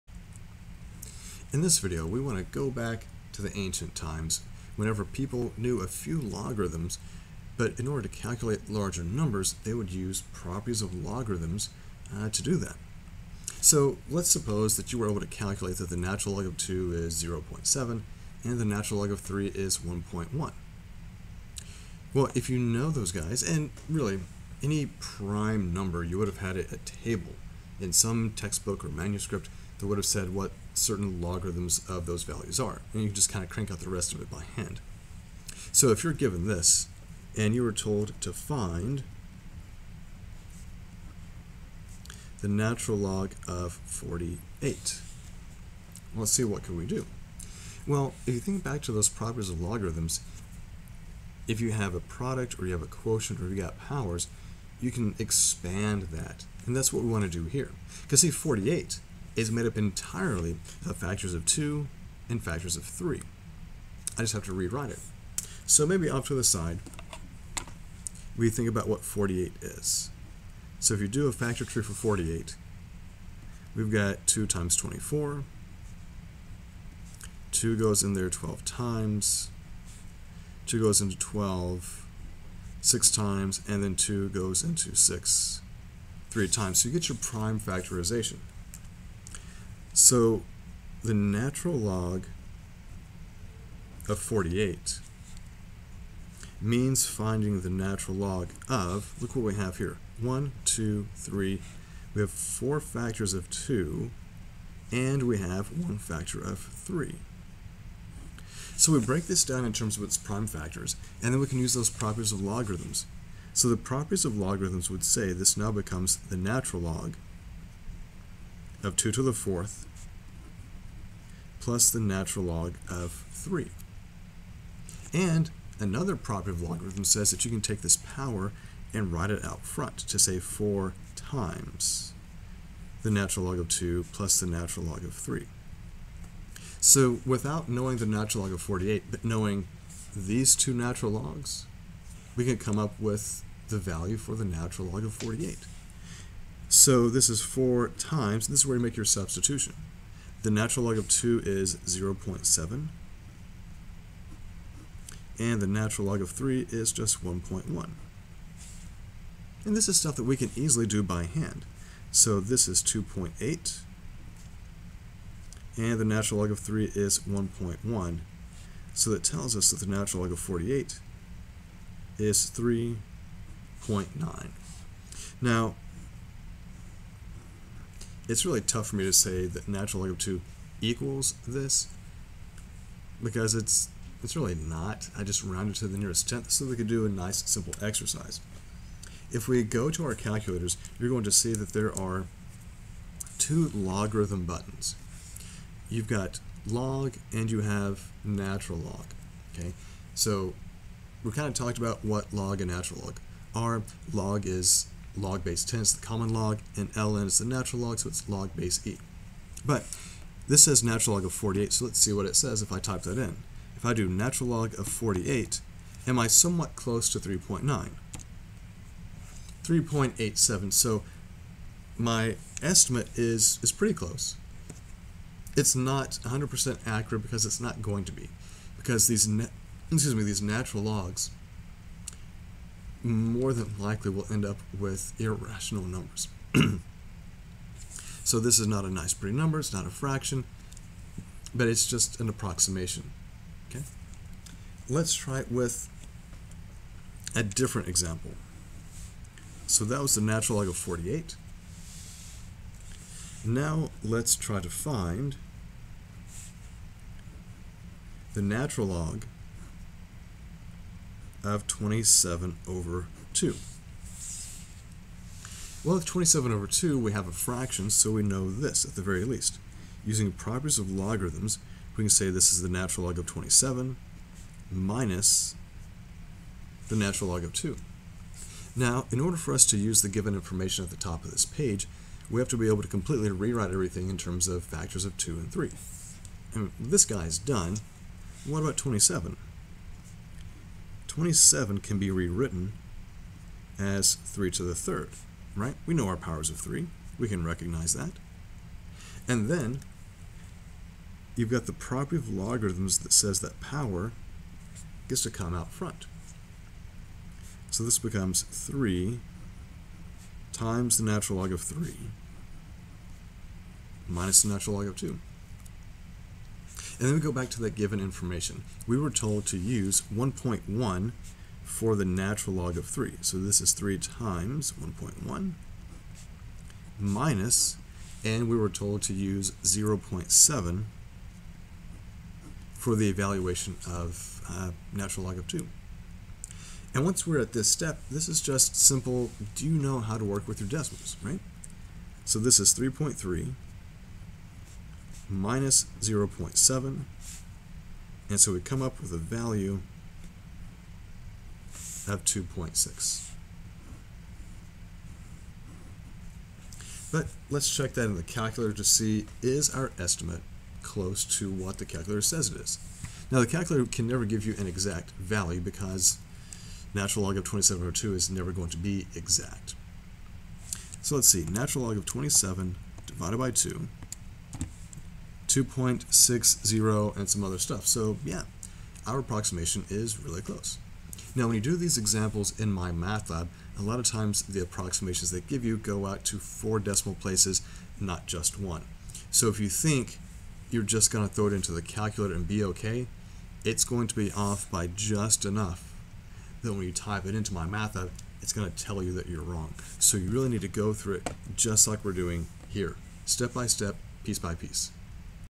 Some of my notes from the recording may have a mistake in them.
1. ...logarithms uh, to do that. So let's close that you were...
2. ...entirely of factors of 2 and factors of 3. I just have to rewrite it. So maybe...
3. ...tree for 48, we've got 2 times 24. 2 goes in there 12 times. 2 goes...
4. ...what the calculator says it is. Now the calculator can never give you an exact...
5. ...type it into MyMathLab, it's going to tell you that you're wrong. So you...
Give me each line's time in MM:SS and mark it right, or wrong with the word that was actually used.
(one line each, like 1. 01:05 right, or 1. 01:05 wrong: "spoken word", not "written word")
1. 00:11 wrong: "suppose", not "close"
2. 00:59 right
3. 01:11 right
4. 06:01 right
5. 06:36 right.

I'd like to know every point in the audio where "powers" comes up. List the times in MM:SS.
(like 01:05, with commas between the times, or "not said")
00:53, 02:07, 04:56, 05:03.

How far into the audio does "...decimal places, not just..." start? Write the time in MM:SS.
06:26.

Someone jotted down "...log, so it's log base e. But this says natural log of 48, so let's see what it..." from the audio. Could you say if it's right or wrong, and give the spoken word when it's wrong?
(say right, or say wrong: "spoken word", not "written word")
right.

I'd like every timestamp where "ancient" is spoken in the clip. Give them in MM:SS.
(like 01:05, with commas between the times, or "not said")
00:03.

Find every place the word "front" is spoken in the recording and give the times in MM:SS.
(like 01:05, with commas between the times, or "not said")
02:09, 05:05.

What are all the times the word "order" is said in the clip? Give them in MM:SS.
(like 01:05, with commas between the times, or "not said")
00:07, 04:39.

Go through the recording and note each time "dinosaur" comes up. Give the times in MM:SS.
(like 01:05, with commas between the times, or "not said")
not said.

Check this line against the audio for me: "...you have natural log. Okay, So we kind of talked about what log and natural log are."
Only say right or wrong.
right.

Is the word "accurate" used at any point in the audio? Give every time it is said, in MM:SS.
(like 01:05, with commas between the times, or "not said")
03:46.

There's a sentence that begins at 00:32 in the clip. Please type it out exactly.
And you can just kind of crank out the rest of it by hand.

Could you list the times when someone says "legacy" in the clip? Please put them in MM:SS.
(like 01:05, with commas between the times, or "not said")
not said.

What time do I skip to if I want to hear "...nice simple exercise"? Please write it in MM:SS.
03:07.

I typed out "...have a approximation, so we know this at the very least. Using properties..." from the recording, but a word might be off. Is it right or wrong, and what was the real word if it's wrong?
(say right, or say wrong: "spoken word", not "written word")
wrong: "fraction", not "approximation".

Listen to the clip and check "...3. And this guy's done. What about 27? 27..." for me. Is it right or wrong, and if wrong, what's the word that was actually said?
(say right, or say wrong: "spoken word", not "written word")
right.